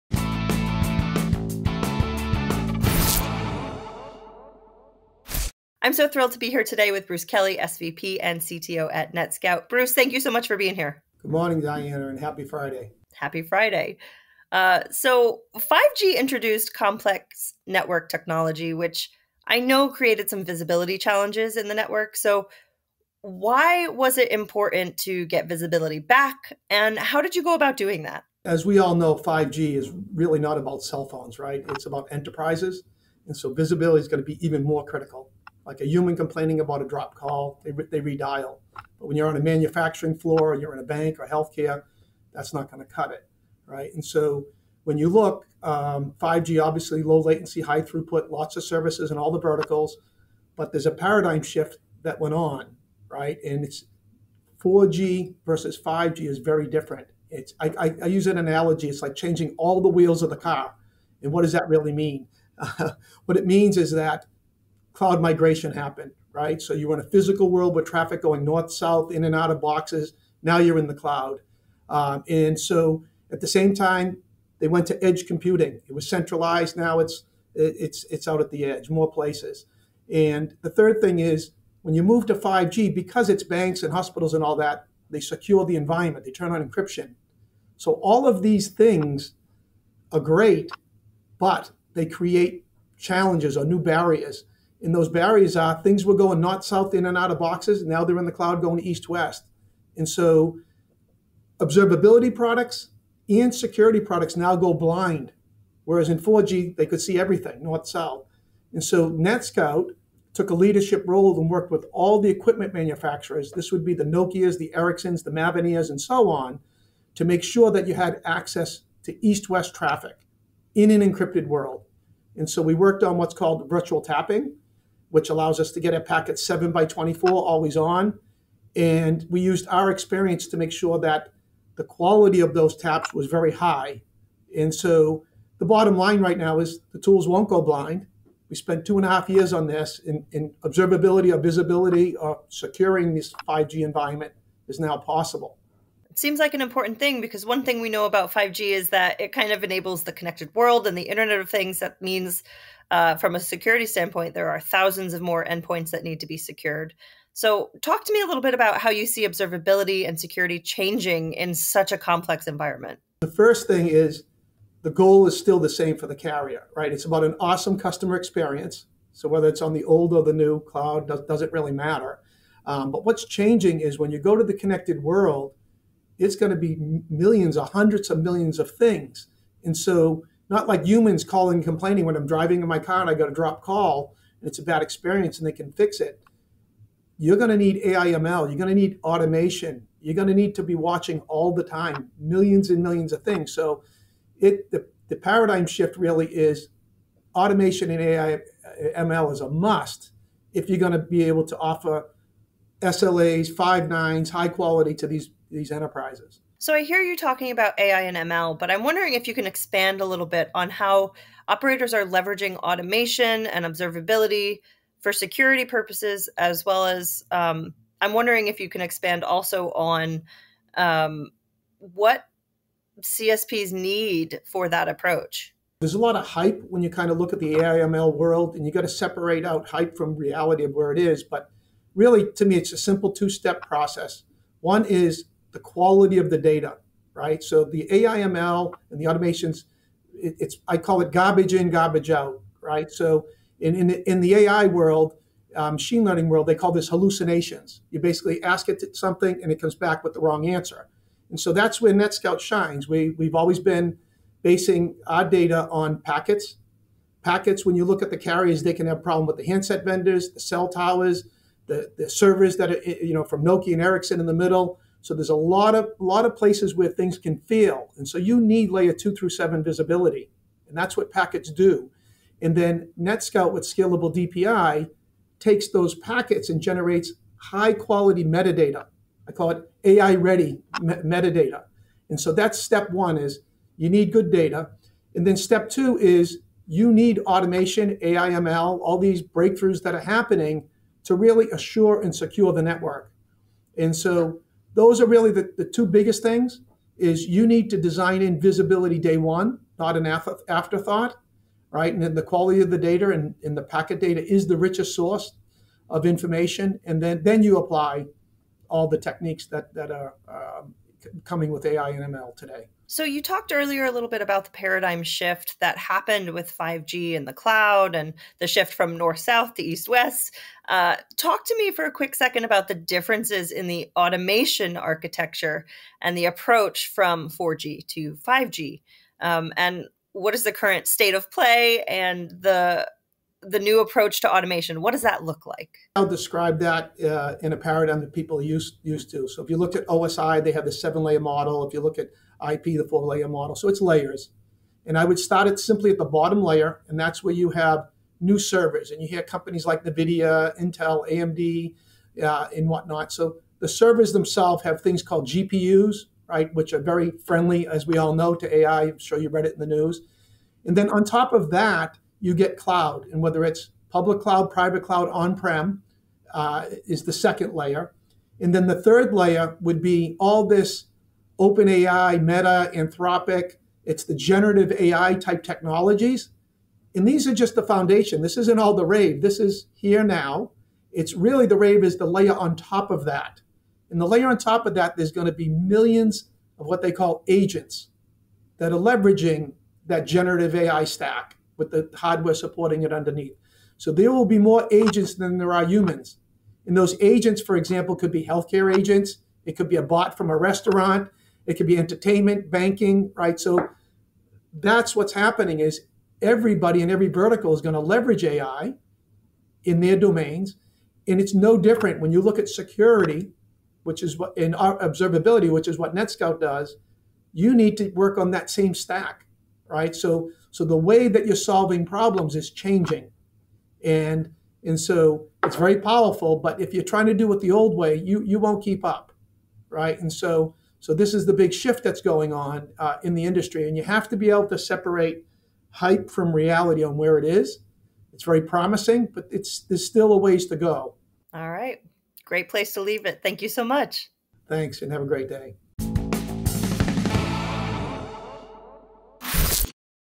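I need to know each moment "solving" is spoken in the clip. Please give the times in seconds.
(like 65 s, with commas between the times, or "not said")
421 s.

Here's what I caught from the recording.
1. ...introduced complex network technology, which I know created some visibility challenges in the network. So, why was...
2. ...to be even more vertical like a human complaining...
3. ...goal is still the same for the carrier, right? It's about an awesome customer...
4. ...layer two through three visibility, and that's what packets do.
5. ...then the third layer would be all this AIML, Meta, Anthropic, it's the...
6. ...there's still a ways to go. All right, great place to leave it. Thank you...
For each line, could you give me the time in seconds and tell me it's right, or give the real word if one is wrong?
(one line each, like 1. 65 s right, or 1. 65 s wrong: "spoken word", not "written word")
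1. 16 s right
2. 34 s wrong: "critical", not "vertical"
3. 164 s right
4. 268 s wrong: "seven", not "three"
5. 368 s wrong: "OpenAI", not "AIML"
6. 439 s right.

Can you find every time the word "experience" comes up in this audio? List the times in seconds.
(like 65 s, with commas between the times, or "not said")
129 s, 168 s, 184 s.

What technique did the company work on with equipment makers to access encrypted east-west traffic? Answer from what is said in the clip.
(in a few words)
virtual tapping.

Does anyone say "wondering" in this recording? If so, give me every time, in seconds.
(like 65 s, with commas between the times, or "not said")
208 s, 218 s.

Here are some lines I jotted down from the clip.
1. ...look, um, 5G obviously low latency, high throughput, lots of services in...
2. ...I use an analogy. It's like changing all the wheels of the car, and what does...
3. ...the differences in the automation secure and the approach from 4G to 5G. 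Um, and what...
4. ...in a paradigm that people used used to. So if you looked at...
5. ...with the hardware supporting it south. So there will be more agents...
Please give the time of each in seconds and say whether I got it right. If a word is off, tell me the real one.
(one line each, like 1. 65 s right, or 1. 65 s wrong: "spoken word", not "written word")
1. 45 s right
2. 58 s right
3. 322 s wrong: "architecture", not "secure"
4. 337 s right
5. 391 s wrong: "underneath", not "south".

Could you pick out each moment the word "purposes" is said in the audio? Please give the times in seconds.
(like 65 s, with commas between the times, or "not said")
215 s.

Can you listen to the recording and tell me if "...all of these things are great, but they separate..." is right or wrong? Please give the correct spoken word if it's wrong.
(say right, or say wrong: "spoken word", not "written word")
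wrong: "create", not "separate".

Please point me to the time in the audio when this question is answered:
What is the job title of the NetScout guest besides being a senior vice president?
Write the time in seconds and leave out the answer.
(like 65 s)
8 s.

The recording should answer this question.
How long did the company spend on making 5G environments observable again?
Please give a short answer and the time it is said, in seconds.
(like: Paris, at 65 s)
two and a half years, at 138 s.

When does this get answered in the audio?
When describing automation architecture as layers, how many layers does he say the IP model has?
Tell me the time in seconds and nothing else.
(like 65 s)
342 s.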